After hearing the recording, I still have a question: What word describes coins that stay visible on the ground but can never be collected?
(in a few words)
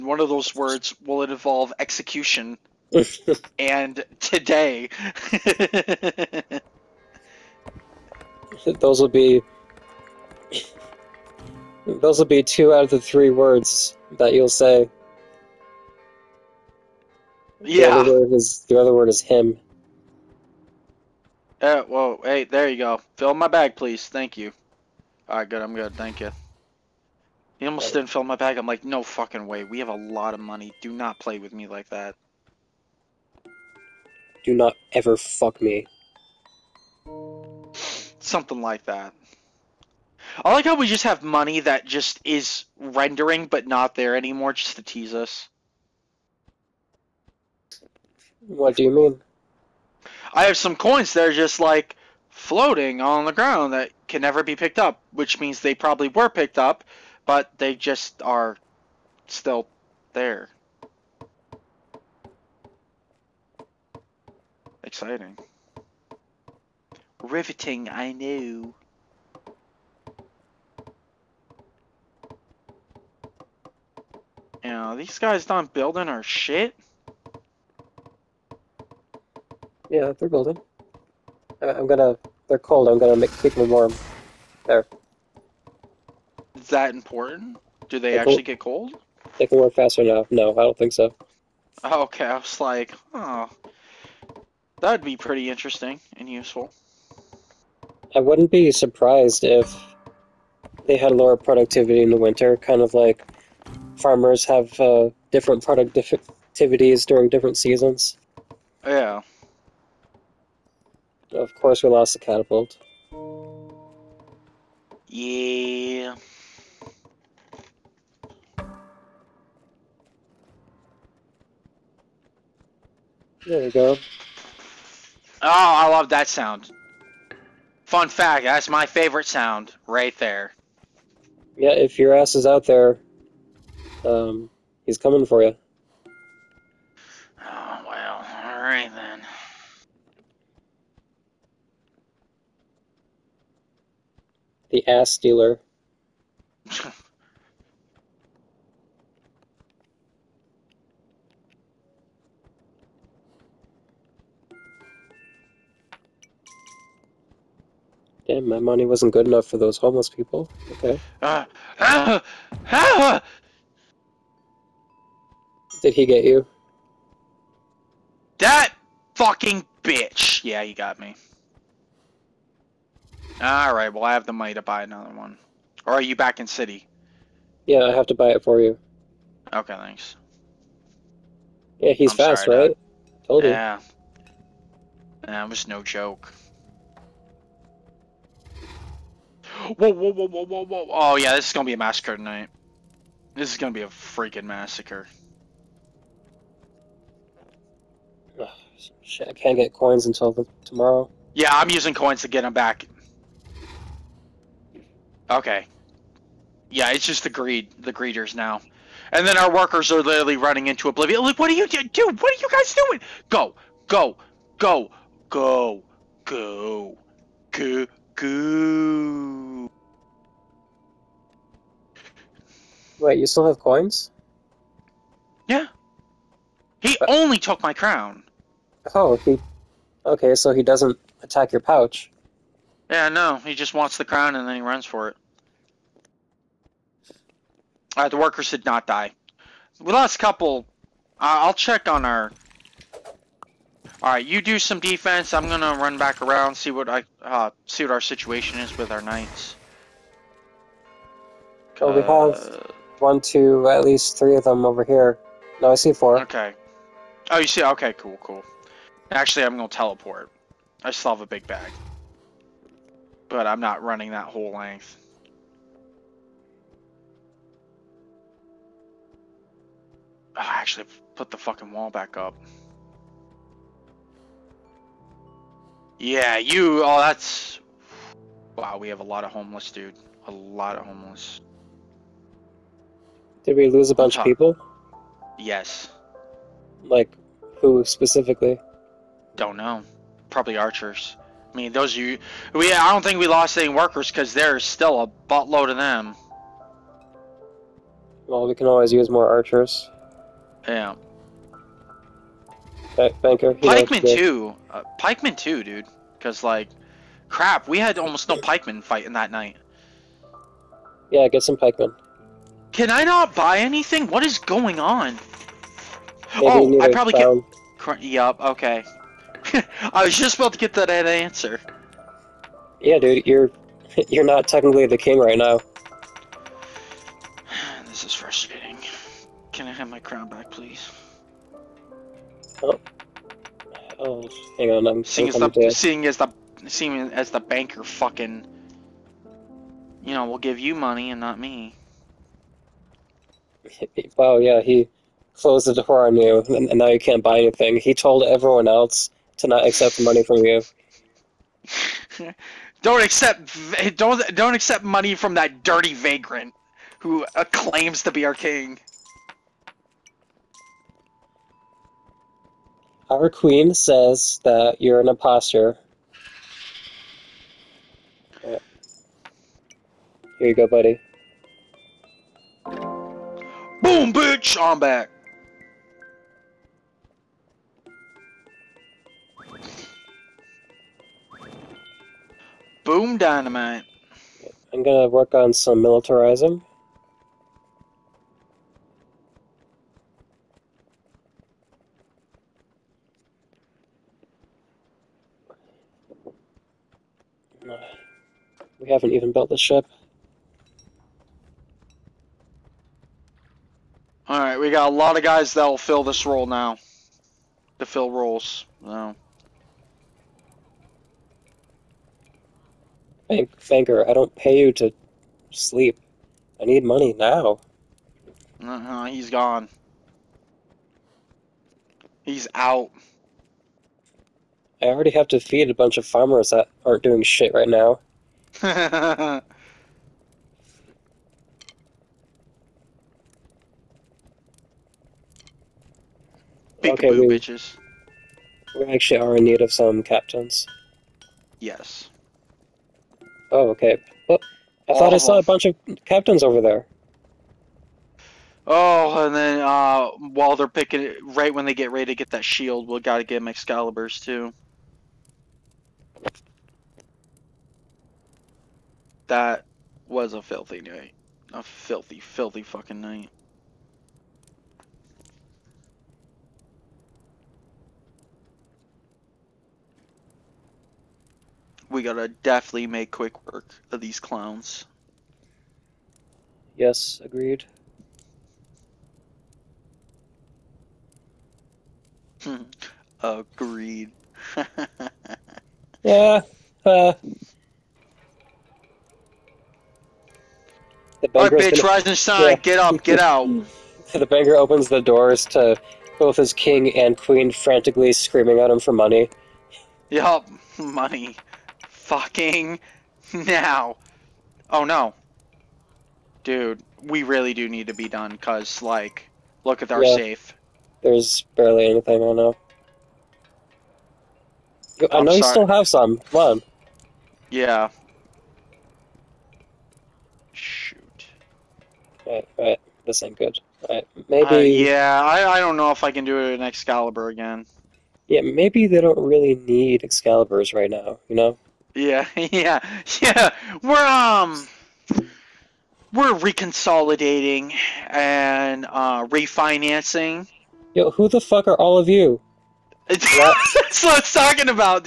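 Floating.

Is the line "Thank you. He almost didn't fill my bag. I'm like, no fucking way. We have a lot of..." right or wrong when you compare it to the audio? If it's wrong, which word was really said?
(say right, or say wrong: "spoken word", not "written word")
right.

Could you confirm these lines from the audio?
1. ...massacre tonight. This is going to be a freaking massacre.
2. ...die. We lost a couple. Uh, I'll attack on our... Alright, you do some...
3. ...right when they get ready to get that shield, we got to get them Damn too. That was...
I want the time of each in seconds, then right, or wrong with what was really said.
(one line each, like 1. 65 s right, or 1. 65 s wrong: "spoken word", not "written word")
1. 191 s right
2. 238 s wrong: "check", not "attack"
3. 451 s wrong: "Excaliburs", not "Damn".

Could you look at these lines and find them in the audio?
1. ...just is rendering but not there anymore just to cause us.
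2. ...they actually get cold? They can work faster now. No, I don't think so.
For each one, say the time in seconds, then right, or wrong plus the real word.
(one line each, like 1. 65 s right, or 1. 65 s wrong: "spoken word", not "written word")
1. 41 s wrong: "tease", not "cause"
2. 88 s right.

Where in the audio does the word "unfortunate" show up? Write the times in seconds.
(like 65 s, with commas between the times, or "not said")
not said.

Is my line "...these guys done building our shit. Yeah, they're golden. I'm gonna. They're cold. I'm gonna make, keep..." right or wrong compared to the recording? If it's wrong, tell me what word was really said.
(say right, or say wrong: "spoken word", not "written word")
right.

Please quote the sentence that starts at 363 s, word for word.
Our queen says that you're an imposter.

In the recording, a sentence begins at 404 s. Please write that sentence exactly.
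Alright, we got a lot of guys that'll fill this role now.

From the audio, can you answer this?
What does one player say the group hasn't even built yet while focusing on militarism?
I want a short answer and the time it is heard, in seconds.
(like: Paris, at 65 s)
The ship, at 399 s.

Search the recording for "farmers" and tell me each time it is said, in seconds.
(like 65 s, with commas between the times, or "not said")
103 s, 426 s.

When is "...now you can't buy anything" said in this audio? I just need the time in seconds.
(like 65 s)
346 s.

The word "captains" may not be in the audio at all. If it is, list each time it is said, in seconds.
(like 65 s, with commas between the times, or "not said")
440 s, 446 s.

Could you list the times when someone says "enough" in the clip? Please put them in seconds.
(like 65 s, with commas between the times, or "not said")
159 s.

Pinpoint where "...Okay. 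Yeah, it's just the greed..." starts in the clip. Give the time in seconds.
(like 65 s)
205 s.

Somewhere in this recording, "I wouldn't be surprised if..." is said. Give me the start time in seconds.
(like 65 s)
98 s.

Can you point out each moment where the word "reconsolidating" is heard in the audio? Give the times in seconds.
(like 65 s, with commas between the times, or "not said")
536 s.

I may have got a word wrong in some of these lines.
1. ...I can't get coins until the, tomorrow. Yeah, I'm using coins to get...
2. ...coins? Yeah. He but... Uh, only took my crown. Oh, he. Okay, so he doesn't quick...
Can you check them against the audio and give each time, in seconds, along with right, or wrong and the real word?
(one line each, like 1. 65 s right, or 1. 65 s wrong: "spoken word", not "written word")
1. 199 s right
2. 223 s wrong: "attack", not "quick".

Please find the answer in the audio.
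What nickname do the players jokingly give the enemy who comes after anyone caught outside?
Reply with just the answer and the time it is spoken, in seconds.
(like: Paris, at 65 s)
The ass dealer, at 144 s.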